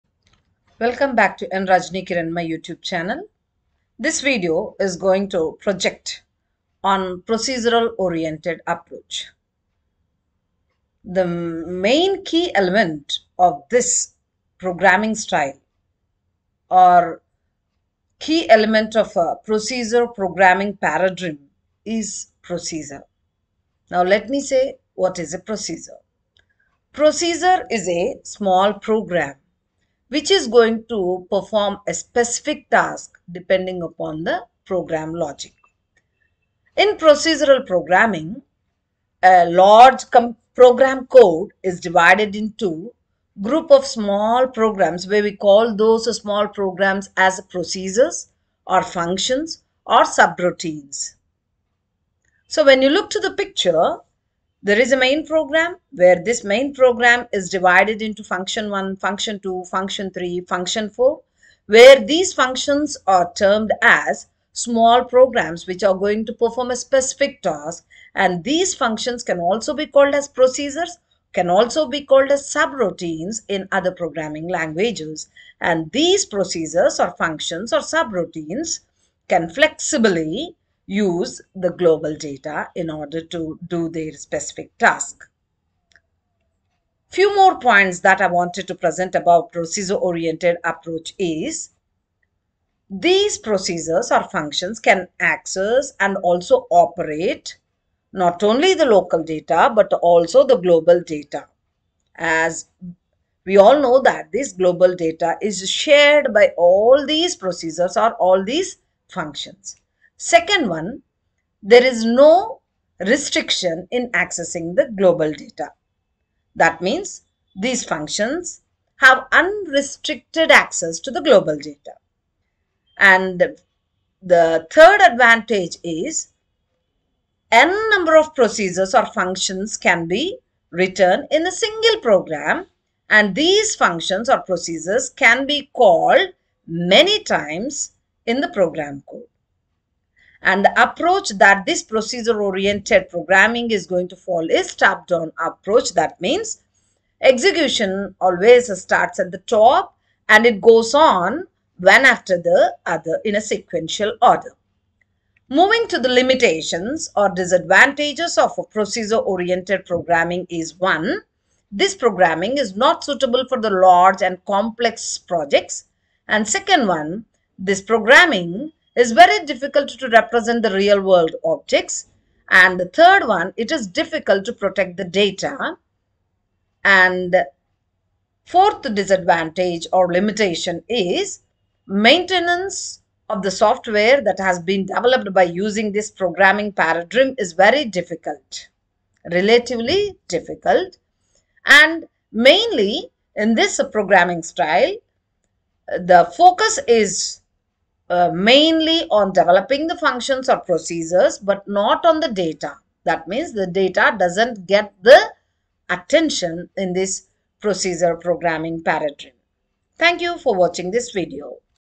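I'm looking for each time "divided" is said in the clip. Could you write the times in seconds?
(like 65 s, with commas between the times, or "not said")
41 s, 57 s.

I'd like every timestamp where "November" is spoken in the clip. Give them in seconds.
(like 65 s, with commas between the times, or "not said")
not said.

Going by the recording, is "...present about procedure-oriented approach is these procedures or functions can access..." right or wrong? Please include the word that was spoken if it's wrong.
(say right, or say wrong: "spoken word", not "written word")
right.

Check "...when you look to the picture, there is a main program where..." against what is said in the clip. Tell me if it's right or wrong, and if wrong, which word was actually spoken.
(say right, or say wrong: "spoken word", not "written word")
right.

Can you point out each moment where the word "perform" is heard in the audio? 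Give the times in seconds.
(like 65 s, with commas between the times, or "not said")
31 s, 66 s.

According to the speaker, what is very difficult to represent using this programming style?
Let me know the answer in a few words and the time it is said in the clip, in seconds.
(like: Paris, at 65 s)
real world objects, at 170 s.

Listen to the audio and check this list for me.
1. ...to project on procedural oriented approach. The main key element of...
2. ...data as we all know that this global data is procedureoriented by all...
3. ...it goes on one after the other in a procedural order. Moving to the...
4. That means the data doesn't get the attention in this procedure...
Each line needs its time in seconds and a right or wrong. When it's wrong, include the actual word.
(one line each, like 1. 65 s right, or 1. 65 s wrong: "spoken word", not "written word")
1. 5 s right
2. 101 s wrong: "shared", not "procedureoriented"
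3. 150 s wrong: "sequential", not "procedural"
4. 203 s right.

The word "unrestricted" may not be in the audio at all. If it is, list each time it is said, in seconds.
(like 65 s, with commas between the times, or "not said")
119 s.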